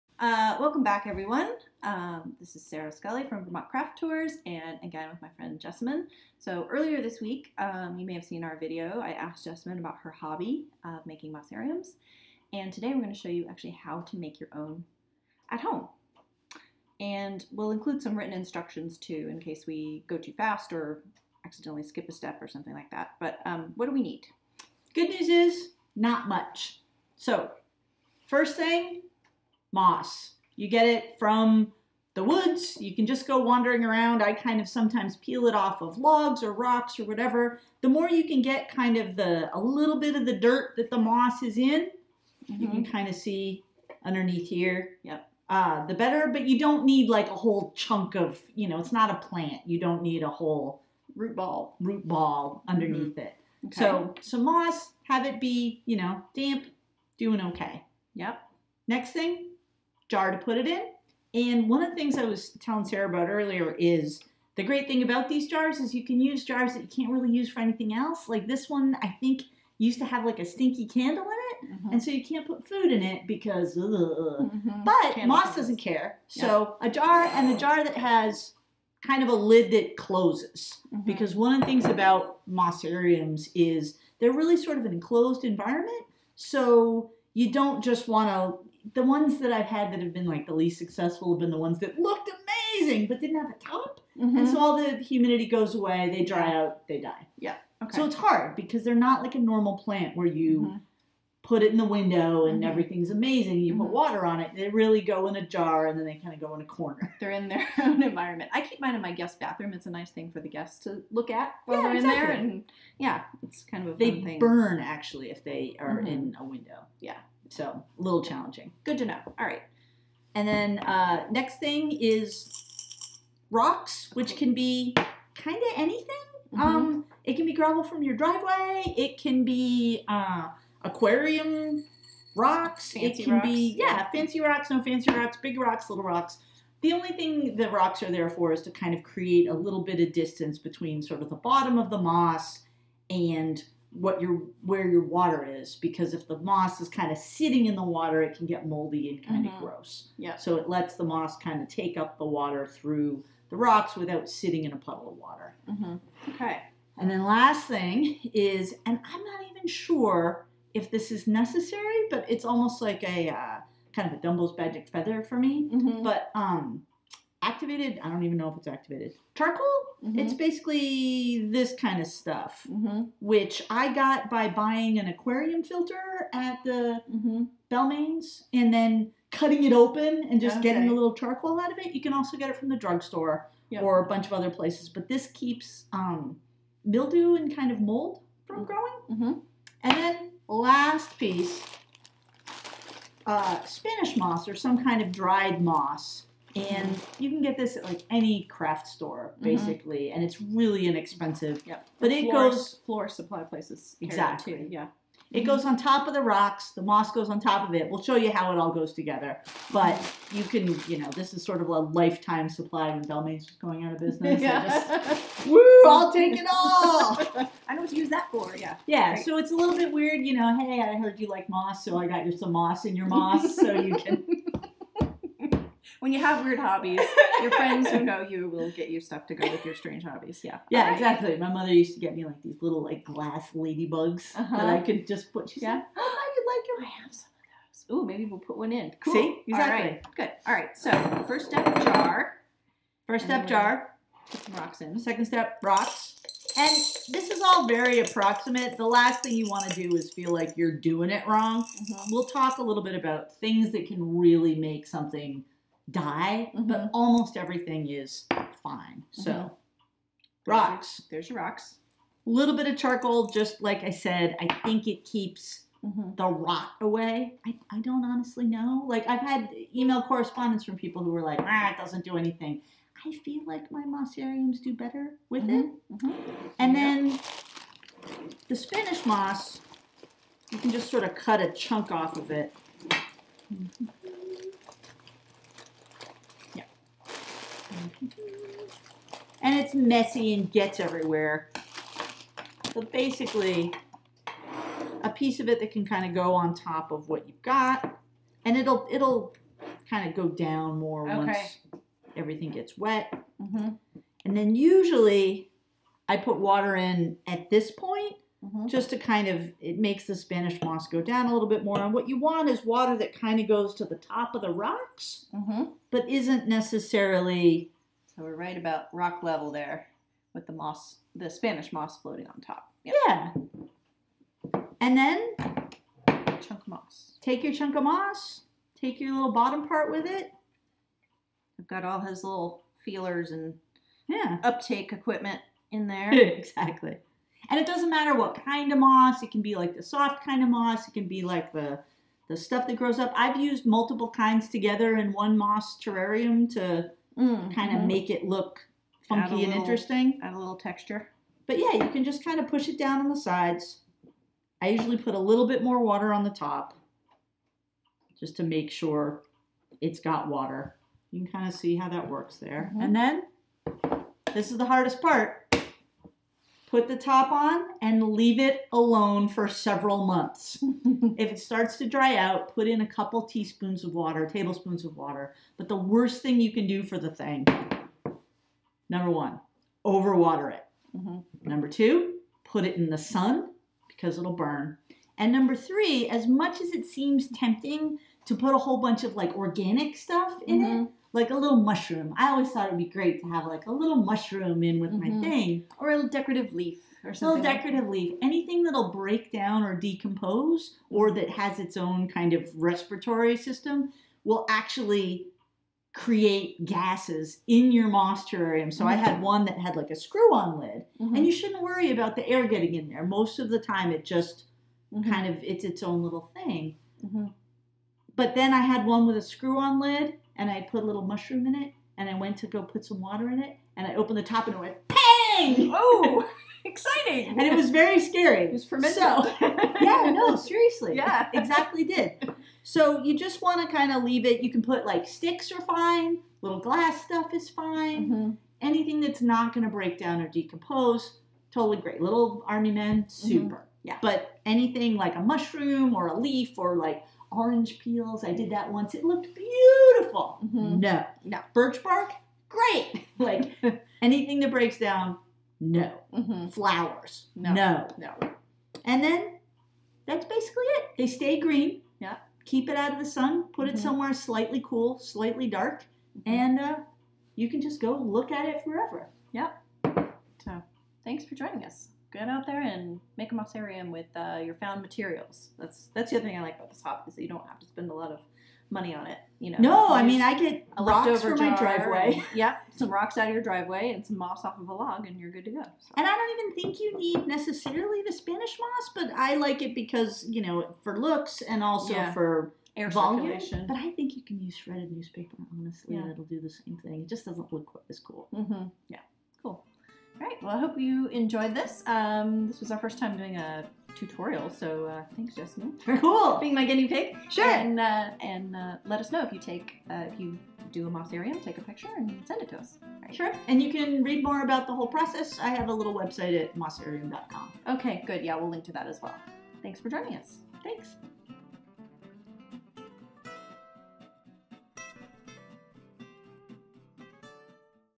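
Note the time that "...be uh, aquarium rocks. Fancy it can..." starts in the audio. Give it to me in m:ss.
2:09.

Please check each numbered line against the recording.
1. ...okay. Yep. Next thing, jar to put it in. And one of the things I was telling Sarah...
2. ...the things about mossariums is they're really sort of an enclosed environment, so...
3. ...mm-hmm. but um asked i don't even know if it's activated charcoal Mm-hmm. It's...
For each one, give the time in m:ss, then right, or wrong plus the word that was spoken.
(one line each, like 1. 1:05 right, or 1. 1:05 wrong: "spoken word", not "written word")
1. 0:57 right
2. 1:21 right
3. 2:45 wrong: "activated", not "asked".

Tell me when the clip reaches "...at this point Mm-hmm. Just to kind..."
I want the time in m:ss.
5:07.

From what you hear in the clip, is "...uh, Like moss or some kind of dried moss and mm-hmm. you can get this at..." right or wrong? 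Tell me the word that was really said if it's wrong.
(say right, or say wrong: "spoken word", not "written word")
wrong: "Spanish", not "Like".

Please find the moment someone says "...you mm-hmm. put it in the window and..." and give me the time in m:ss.
1:40.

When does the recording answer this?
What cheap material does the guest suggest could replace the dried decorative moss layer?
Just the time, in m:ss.
8:14.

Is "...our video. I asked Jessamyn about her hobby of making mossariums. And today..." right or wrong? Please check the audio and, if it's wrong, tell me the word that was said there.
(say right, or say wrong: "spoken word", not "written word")
right.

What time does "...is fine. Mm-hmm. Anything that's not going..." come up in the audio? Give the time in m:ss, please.
7:17.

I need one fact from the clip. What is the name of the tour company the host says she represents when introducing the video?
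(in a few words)
Vermont Craft Tours.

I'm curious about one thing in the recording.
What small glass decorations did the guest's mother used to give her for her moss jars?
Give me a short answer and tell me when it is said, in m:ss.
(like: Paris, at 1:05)
ladybugs, at 3:53.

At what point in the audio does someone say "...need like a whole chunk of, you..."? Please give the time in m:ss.
0:46.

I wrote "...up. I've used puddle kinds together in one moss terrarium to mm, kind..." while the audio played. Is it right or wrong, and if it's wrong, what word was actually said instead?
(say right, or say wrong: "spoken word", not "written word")
wrong: "multiple", not "puddle".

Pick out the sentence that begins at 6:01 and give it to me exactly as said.
You can kind of see how that works there.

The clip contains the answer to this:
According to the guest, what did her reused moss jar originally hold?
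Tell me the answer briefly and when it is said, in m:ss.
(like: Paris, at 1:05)
a stinky candle, at 1:10.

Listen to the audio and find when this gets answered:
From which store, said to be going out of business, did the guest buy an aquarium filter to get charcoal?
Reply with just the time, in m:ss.
2:57.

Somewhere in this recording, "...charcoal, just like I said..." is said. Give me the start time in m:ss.
4:22.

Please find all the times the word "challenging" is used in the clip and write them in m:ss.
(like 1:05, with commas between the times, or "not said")
1:58.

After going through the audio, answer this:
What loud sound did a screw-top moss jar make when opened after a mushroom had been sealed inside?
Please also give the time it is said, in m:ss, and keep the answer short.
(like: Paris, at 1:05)
bang, at 7:04.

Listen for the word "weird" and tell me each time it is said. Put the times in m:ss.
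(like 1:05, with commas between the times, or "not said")
3:39, 3:46.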